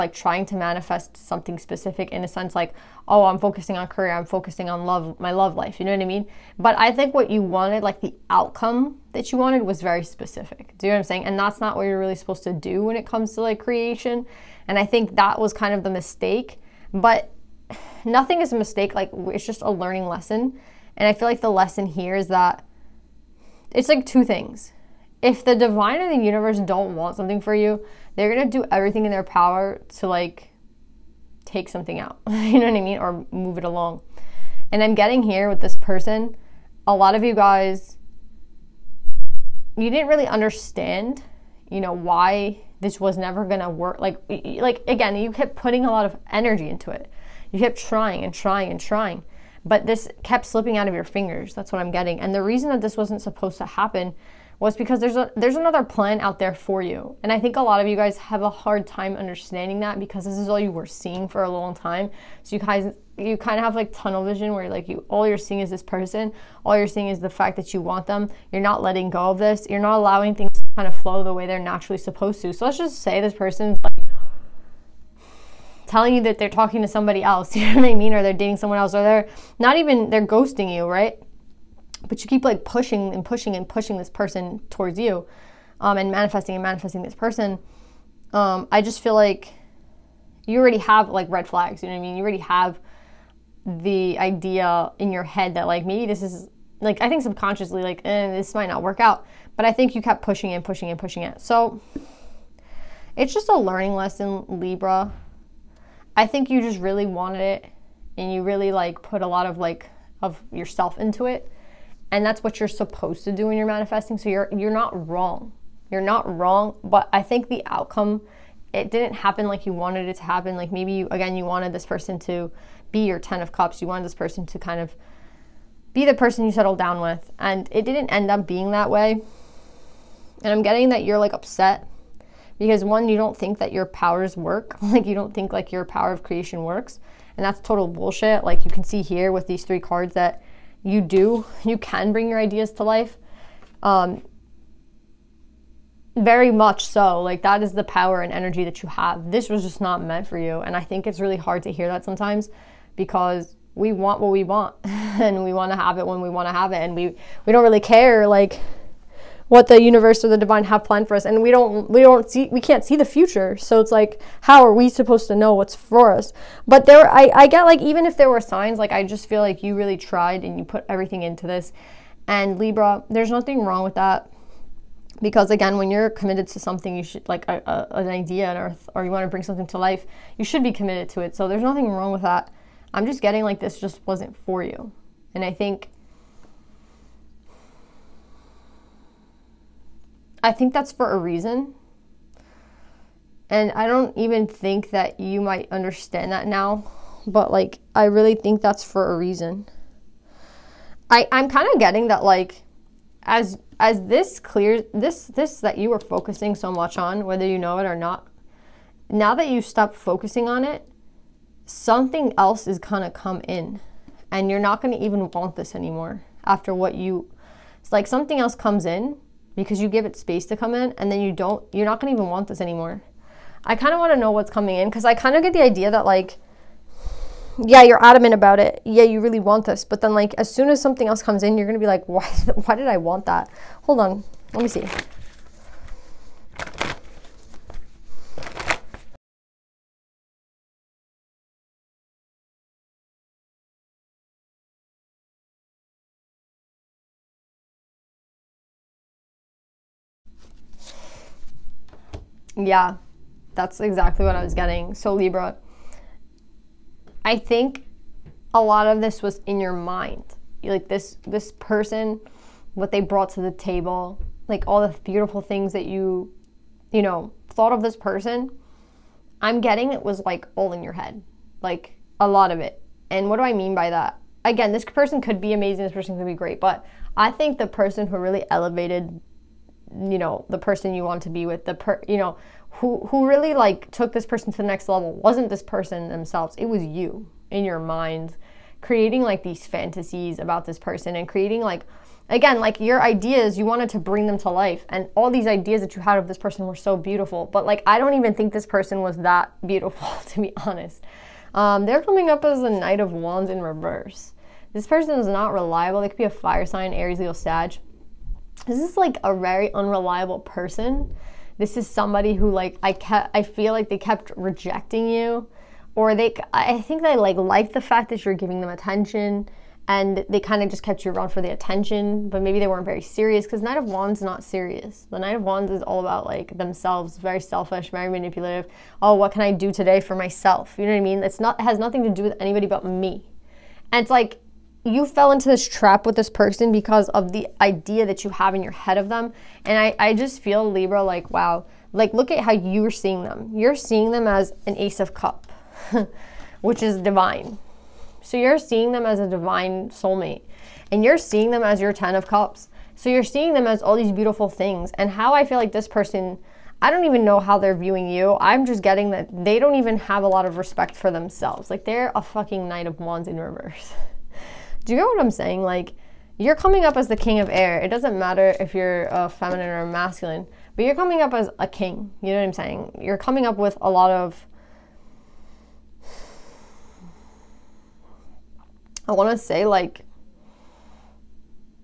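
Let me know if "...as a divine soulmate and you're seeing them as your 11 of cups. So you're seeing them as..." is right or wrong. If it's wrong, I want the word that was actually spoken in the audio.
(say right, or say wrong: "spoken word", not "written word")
wrong: "10", not "11".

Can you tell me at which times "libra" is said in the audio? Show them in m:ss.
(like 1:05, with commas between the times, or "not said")
1:44, 2:52, 4:15, 5:40.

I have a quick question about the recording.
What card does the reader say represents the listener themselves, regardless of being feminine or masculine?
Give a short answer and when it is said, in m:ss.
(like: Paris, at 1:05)
King of Air, at 6:07.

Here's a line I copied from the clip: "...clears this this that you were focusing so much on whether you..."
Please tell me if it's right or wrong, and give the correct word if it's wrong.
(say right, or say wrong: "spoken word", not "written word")
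right.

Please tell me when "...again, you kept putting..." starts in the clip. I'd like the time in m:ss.
0:44.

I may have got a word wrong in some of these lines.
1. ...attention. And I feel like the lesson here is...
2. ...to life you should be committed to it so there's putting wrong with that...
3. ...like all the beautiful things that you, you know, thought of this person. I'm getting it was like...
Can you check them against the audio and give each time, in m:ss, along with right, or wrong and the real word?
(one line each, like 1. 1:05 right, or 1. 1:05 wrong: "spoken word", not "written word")
1. 0:20 wrong: "lesson", not "attention"
2. 2:59 wrong: "nothing", not "putting"
3. 4:24 right.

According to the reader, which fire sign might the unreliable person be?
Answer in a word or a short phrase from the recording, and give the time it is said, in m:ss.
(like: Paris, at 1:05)
Aries, at 5:06.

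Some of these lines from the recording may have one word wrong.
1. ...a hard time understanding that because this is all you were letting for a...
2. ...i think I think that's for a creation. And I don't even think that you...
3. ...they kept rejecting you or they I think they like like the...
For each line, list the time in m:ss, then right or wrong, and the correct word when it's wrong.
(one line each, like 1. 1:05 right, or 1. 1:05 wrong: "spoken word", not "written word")
1. 0:58 wrong: "seeing", not "letting"
2. 3:05 wrong: "reason", not "creation"
3. 5:13 right.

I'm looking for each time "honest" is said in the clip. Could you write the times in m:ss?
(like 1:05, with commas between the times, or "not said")
5:00.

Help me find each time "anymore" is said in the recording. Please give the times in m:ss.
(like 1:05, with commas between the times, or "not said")
3:35, 3:42.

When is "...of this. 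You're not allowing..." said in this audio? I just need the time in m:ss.
1:09.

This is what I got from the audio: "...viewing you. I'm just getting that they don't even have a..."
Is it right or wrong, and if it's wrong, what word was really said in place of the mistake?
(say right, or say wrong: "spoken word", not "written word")
right.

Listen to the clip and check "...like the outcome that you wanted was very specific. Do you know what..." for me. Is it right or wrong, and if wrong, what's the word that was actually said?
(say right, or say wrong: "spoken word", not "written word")
right.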